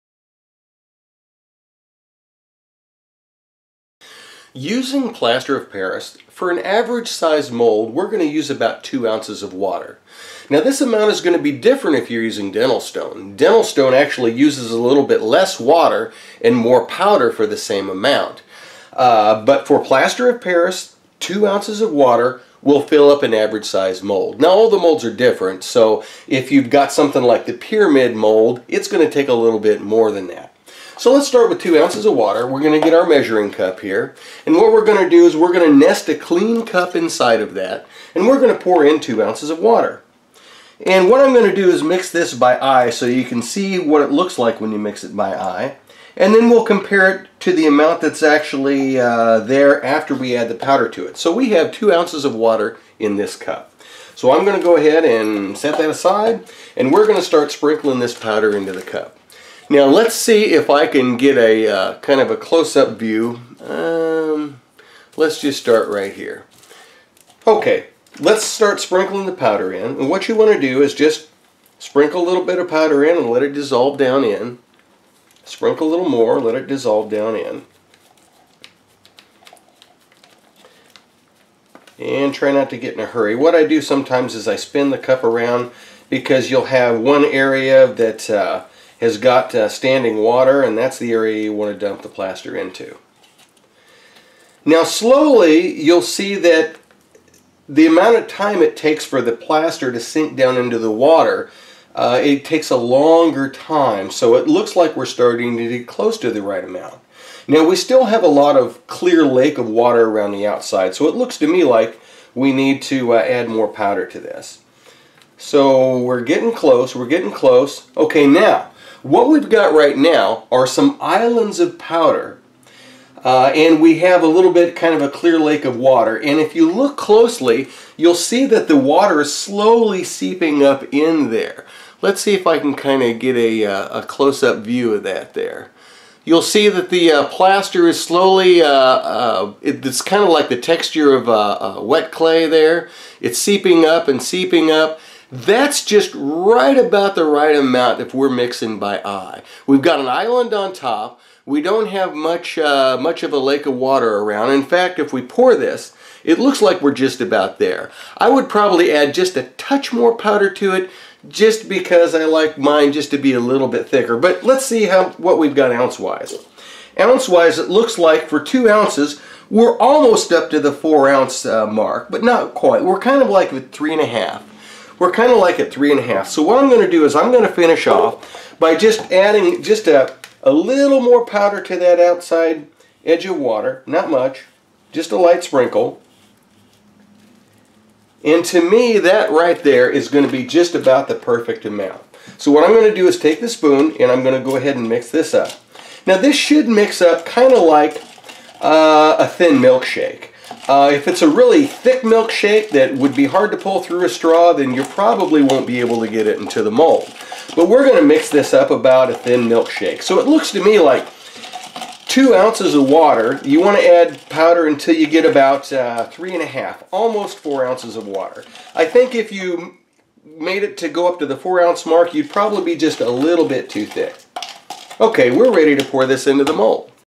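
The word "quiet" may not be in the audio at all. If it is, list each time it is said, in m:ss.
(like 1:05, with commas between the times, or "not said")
not said.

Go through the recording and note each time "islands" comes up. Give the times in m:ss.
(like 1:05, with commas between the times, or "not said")
2:01, 2:30.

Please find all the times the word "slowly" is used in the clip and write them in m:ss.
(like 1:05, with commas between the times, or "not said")
1:34, 2:09, 2:18.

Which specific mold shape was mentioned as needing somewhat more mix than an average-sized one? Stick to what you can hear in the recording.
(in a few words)
pyramid.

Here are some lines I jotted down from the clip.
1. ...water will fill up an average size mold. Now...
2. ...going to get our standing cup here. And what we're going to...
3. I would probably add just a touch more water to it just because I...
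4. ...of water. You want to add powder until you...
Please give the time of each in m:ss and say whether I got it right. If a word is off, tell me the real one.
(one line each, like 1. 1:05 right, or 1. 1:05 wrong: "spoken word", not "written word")
1. 0:21 right
2. 0:32 wrong: "measuring", not "standing"
3. 2:38 wrong: "powder", not "water"
4. 3:32 right.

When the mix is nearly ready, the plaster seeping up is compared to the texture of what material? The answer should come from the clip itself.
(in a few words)
wet clay.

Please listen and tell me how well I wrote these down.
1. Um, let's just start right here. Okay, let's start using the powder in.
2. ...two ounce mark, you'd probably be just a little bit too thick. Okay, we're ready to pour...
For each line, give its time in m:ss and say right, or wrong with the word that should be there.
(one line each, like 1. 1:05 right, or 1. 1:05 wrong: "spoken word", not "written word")
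1. 1:03 wrong: "sprinkling", not "using"
2. 3:41 wrong: "four", not "two".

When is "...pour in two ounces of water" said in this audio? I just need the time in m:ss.
0:38.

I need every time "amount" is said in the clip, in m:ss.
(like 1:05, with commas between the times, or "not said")
0:10, 0:17, 0:47, 1:37, 1:46, 2:27, 3:11.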